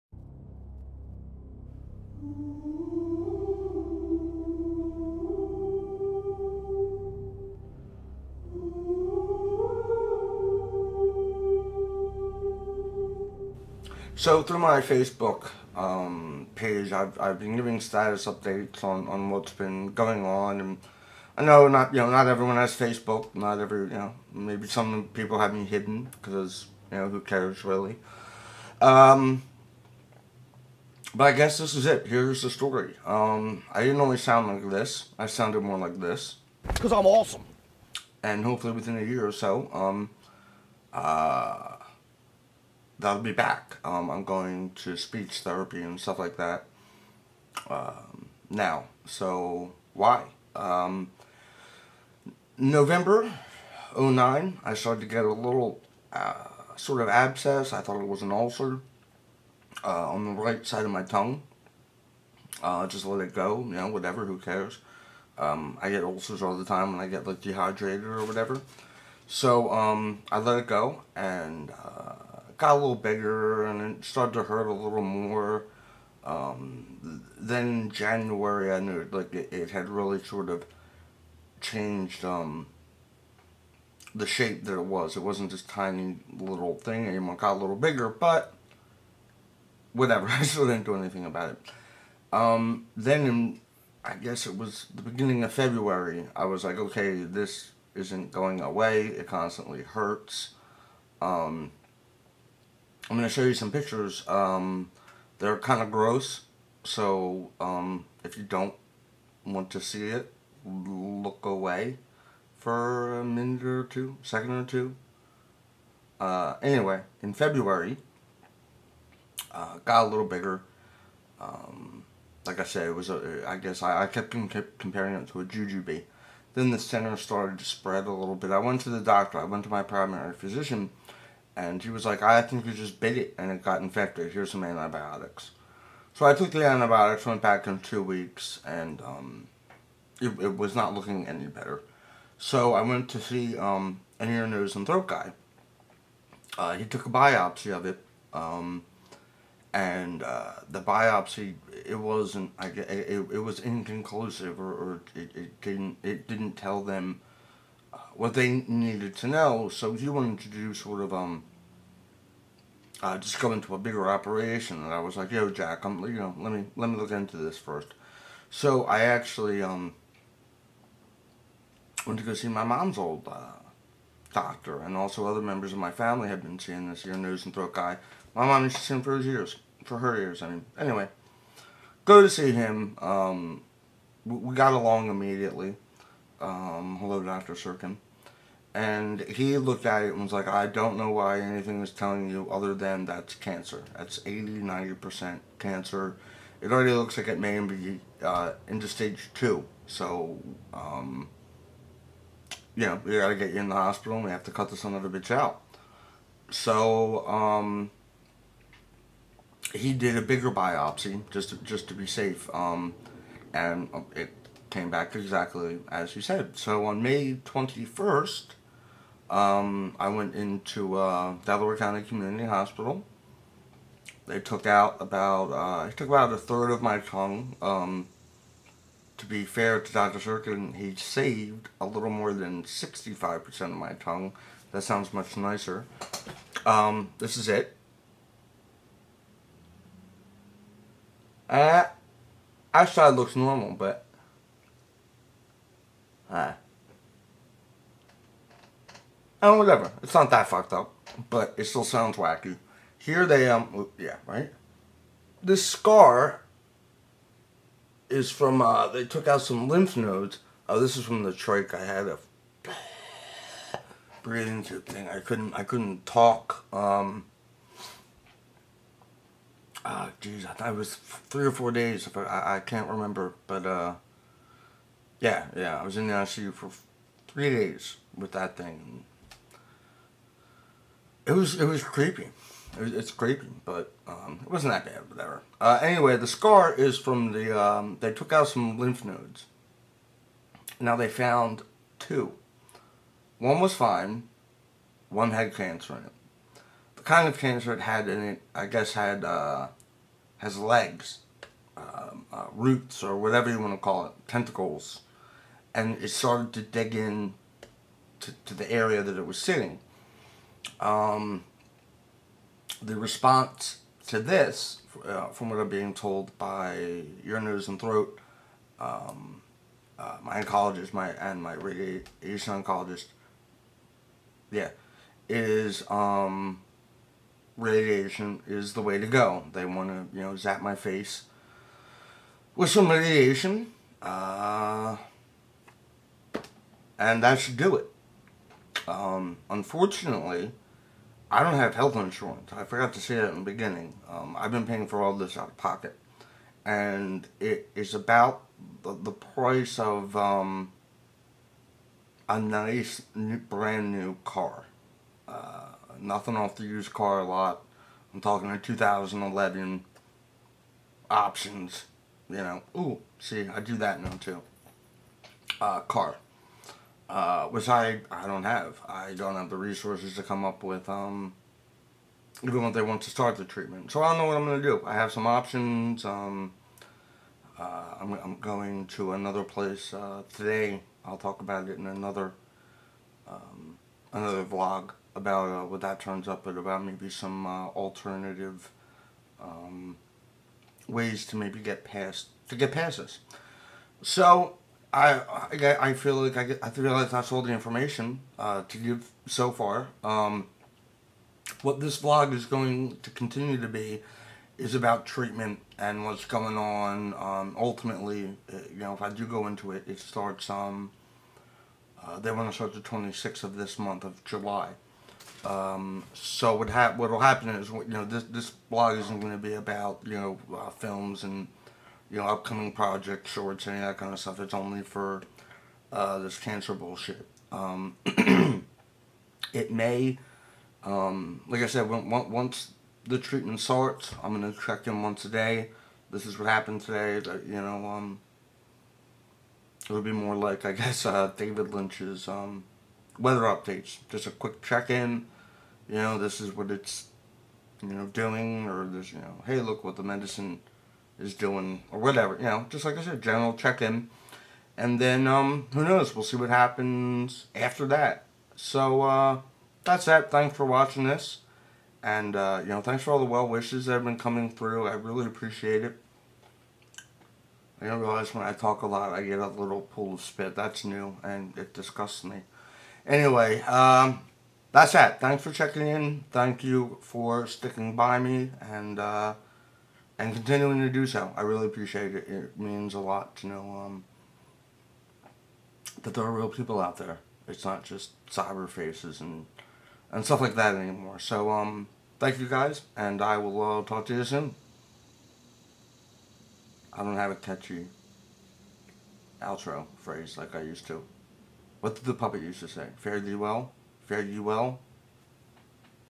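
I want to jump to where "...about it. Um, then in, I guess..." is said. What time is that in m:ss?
1:31.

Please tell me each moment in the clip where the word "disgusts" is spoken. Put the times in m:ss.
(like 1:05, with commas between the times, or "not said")
7:51.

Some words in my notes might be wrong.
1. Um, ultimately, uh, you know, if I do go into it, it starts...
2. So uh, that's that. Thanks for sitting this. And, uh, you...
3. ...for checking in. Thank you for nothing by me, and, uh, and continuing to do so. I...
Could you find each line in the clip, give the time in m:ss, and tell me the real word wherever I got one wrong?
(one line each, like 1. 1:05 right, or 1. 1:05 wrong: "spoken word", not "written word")
1. 6:47 right
2. 7:38 wrong: "watching", not "sitting"
3. 7:55 wrong: "sticking", not "nothing".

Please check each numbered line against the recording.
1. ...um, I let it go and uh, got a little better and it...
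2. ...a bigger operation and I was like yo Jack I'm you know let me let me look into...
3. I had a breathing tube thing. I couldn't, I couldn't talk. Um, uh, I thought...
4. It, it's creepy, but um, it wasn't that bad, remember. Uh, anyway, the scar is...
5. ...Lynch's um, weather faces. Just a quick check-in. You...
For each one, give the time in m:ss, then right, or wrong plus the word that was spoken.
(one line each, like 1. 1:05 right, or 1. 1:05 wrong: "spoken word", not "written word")
1. 1:09 wrong: "bigger", not "better"
2. 2:43 right
3. 4:21 right
4. 4:42 wrong: "whatever", not "remember"
5. 7:21 wrong: "updates", not "faces".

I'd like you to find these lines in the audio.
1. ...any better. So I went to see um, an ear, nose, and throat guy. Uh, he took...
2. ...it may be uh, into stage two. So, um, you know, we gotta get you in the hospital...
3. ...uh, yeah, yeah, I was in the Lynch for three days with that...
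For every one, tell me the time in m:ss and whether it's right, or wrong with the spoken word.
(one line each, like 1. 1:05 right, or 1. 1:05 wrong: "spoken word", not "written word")
1. 2:21 right
2. 3:17 right
3. 4:33 wrong: "ICU", not "Lynch".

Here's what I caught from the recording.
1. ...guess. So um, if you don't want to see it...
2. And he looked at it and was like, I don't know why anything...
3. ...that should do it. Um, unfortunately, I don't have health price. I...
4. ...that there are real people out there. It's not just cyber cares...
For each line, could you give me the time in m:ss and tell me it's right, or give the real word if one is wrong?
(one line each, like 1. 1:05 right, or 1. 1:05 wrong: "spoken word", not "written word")
1. 1:45 wrong: "gross", not "guess"
2. 3:08 right
3. 5:37 wrong: "insurance", not "price"
4. 8:06 wrong: "faces", not "cares".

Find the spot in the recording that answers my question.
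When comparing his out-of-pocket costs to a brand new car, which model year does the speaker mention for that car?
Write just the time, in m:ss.
5:58.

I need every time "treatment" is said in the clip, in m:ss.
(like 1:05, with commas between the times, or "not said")
6:13, 6:45, 7:13.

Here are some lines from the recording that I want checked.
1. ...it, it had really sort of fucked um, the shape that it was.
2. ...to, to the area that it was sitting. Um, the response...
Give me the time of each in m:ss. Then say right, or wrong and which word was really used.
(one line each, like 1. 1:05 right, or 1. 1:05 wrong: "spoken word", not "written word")
1. 1:19 wrong: "changed", not "fucked"
2. 5:08 right.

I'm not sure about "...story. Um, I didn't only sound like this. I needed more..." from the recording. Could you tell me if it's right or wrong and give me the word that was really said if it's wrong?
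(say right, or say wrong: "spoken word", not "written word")
wrong: "sounded", not "needed".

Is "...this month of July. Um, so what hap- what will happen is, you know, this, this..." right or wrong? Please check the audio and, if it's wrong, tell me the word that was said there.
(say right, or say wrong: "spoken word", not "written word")
right.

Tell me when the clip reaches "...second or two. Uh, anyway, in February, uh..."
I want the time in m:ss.
1:54.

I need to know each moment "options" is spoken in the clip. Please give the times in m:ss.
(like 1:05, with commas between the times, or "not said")
6:01, 6:15.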